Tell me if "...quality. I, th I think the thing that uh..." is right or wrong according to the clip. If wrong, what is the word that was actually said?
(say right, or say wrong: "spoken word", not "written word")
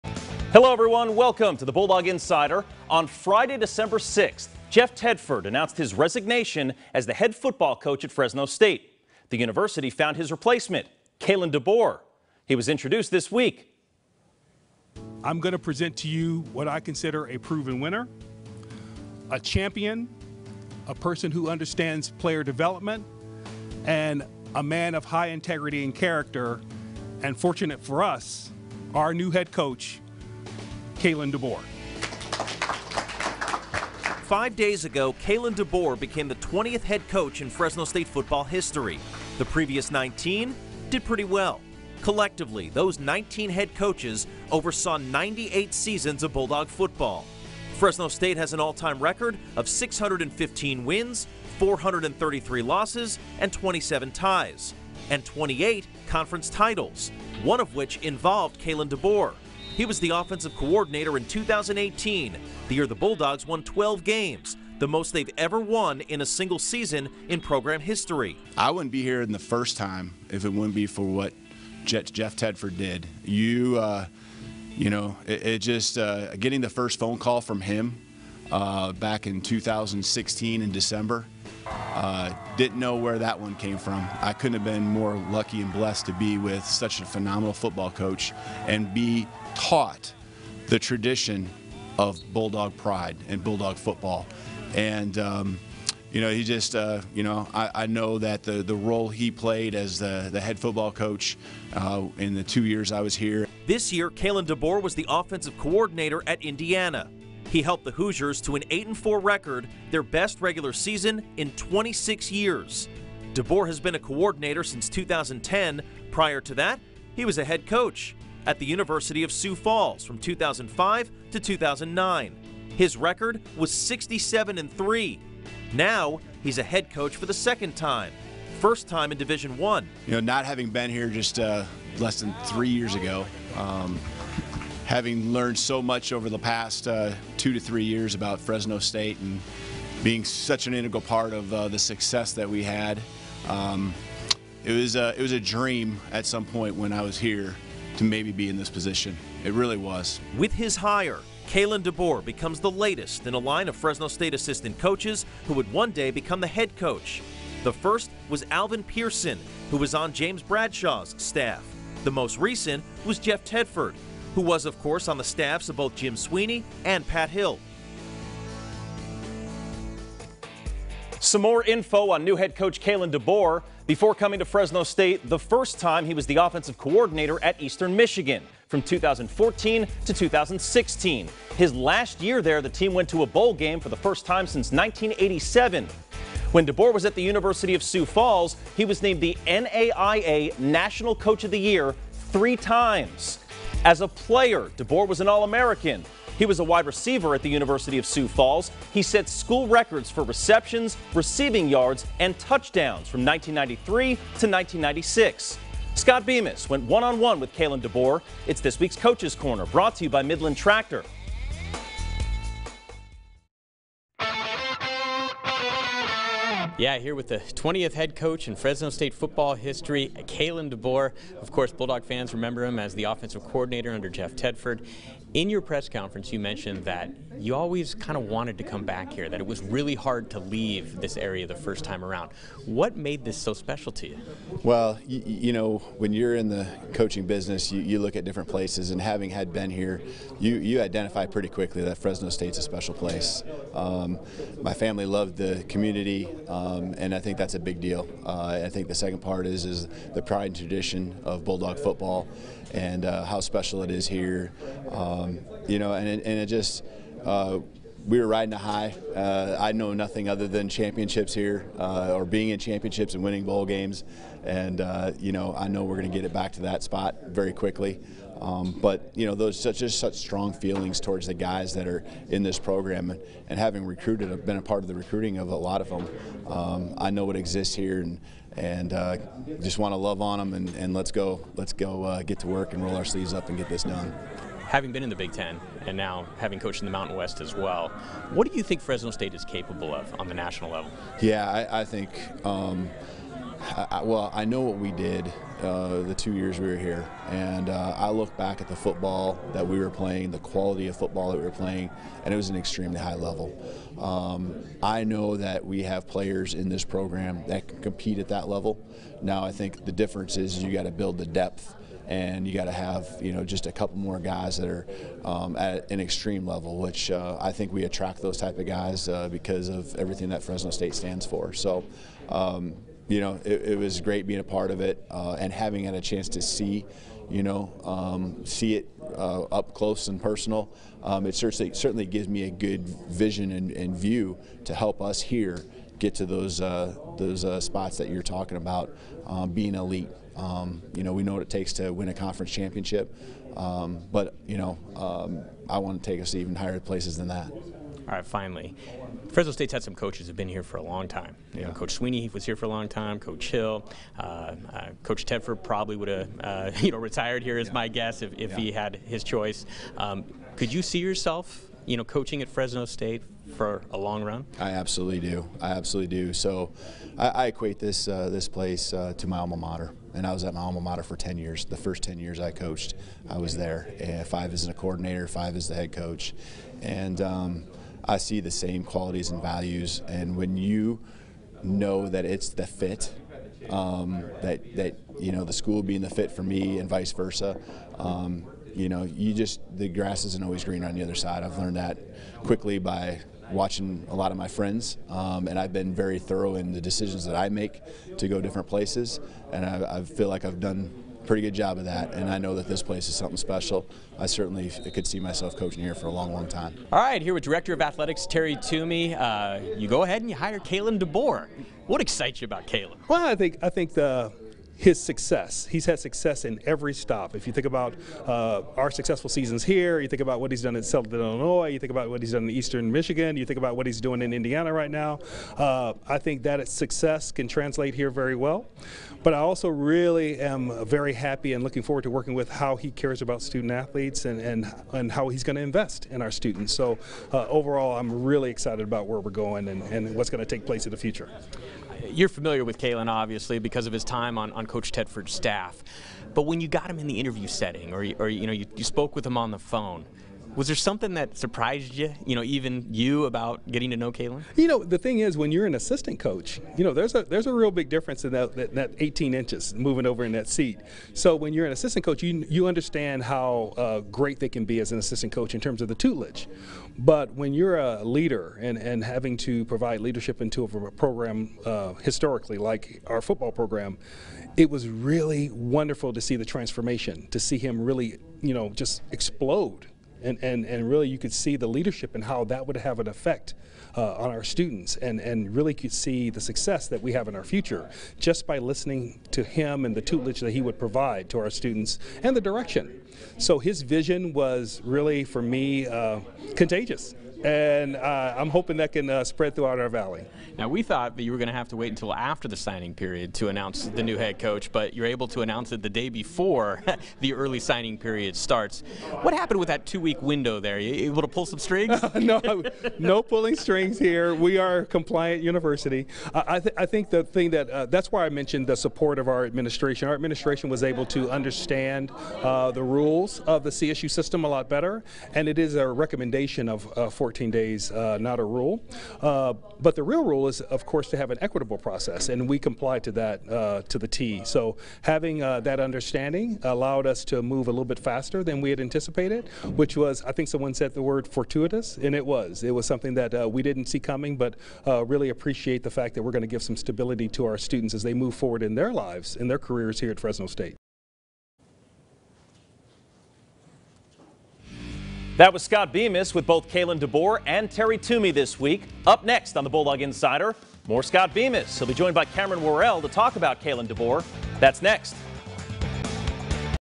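wrong: "university", not "quality".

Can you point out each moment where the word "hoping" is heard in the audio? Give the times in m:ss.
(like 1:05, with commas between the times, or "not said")
8:18.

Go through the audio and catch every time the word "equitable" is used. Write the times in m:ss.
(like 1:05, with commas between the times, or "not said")
8:51.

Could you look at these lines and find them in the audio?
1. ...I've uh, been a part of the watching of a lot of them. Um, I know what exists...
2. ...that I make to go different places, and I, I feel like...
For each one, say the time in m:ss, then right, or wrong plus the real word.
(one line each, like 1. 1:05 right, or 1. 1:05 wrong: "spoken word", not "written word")
1. 4:34 wrong: "recruiting", not "watching"
2. 6:37 right.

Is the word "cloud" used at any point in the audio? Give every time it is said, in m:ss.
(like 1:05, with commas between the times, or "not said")
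not said.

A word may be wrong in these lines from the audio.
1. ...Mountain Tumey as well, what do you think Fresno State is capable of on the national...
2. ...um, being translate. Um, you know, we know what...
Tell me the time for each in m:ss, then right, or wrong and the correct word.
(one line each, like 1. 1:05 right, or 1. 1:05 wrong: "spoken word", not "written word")
1. 4:46 wrong: "West", not "Tumey"
2. 5:39 wrong: "elite", not "translate".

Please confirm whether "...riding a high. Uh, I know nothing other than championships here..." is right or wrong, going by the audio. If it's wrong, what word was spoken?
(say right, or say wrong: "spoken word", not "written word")
right.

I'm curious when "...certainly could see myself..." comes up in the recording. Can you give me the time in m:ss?
6:44.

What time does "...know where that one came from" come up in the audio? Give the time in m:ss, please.
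1:22.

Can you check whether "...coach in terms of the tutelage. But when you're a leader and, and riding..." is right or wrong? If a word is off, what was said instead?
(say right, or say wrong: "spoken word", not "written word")
wrong: "having", not "riding".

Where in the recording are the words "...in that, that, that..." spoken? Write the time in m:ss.
7:38.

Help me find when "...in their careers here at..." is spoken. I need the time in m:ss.
9:09.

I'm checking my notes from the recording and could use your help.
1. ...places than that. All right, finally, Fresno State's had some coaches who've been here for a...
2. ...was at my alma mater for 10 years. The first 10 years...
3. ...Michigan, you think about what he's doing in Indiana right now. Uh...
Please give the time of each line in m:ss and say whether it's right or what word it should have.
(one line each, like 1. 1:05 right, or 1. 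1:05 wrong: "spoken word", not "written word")
1. 5:46 right
2. 6:10 right
3. 7:02 right.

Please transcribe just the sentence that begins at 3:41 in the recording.
Of course, Bulldog fans remember him as the offensive coordinator under Jeff Tedford.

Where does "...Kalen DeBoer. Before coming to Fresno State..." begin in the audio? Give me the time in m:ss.
2:52.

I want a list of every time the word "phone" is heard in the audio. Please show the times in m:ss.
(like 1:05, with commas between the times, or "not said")
1:16, 7:29.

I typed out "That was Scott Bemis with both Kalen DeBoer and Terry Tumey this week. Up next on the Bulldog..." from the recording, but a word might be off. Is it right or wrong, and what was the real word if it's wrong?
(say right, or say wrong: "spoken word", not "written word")
right.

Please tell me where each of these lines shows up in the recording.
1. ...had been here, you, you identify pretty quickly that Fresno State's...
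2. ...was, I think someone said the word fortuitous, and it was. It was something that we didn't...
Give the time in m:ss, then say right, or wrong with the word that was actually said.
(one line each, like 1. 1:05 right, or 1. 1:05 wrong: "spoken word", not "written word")
1. 3:59 right
2. 8:59 right.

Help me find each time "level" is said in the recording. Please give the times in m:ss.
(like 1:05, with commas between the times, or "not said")
4:50, 5:03, 5:08, 5:16.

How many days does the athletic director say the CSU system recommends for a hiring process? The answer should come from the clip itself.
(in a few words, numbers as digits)
14.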